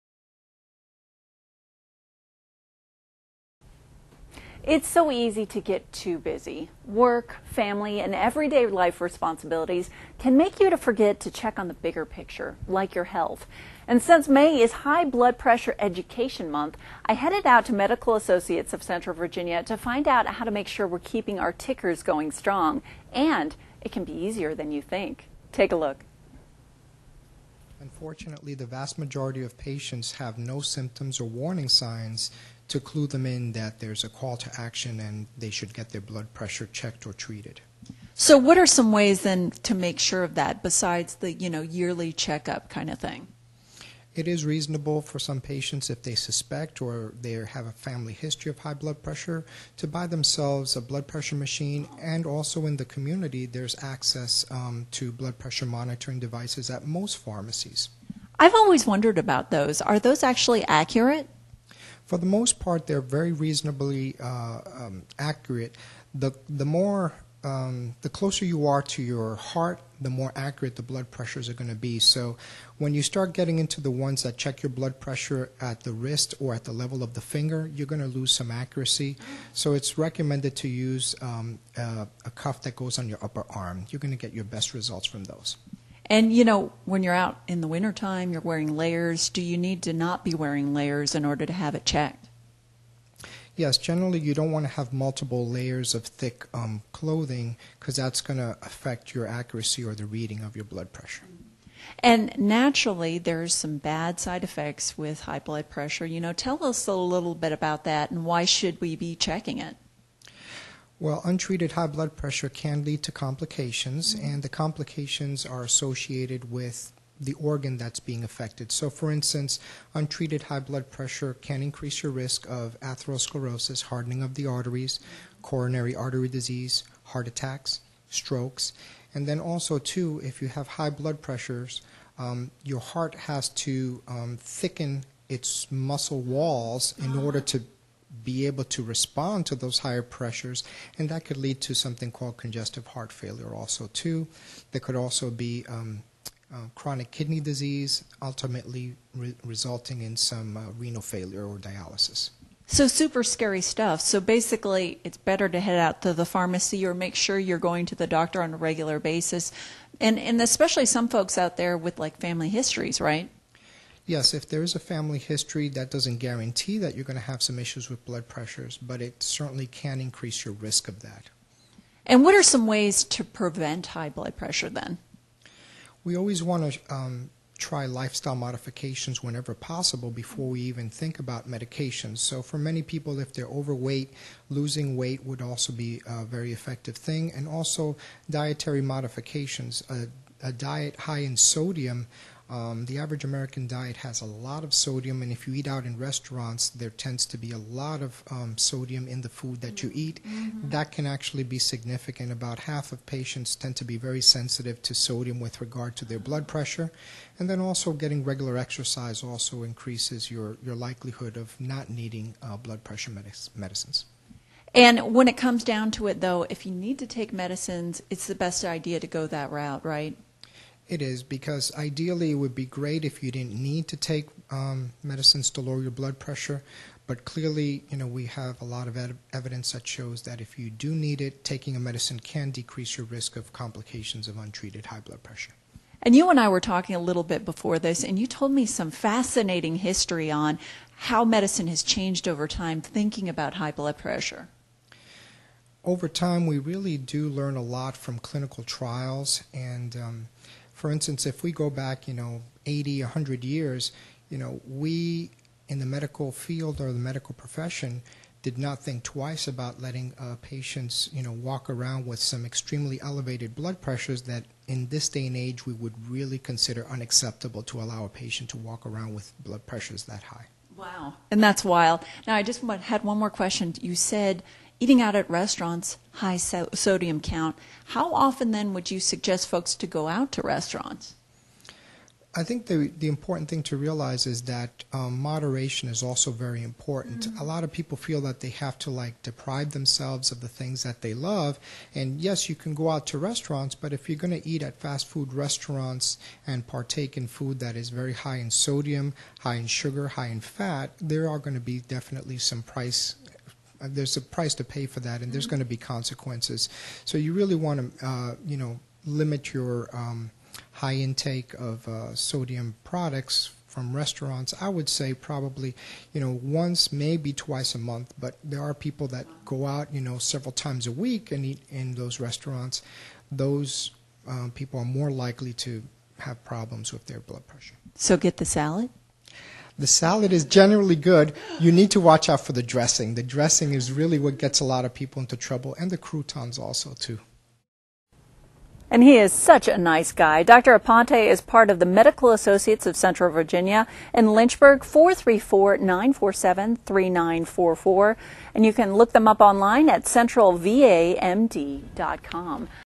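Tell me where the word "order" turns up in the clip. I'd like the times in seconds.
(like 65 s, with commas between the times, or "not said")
91 s, 137 s.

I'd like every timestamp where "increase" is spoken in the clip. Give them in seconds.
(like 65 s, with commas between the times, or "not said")
121 s, 170 s, 209 s.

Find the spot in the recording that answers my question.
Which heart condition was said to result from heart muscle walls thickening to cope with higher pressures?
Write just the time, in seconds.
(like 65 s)
142 s.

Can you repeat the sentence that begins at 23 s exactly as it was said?
And it can be easier than you think.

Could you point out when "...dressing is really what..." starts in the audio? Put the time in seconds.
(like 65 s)
333 s.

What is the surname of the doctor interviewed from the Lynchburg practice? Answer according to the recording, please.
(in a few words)
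Aponte.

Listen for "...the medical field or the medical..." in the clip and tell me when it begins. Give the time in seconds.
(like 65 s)
255 s.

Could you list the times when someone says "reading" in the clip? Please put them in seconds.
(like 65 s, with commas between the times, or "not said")
100 s.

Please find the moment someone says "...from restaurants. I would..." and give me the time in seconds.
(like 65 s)
313 s.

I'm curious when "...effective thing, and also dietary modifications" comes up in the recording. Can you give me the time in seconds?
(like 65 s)
186 s.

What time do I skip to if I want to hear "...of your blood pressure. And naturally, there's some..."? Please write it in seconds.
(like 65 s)
100 s.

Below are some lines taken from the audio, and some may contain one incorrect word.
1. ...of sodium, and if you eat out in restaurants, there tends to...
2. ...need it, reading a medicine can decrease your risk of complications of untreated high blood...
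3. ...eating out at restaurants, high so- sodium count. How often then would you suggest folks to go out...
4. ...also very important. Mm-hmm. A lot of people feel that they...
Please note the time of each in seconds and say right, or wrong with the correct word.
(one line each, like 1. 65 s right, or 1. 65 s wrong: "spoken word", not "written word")
1. 194 s right
2. 230 s wrong: "taking", not "reading"
3. 274 s right
4. 286 s right.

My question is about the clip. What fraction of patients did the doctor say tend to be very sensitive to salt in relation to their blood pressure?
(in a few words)
About half.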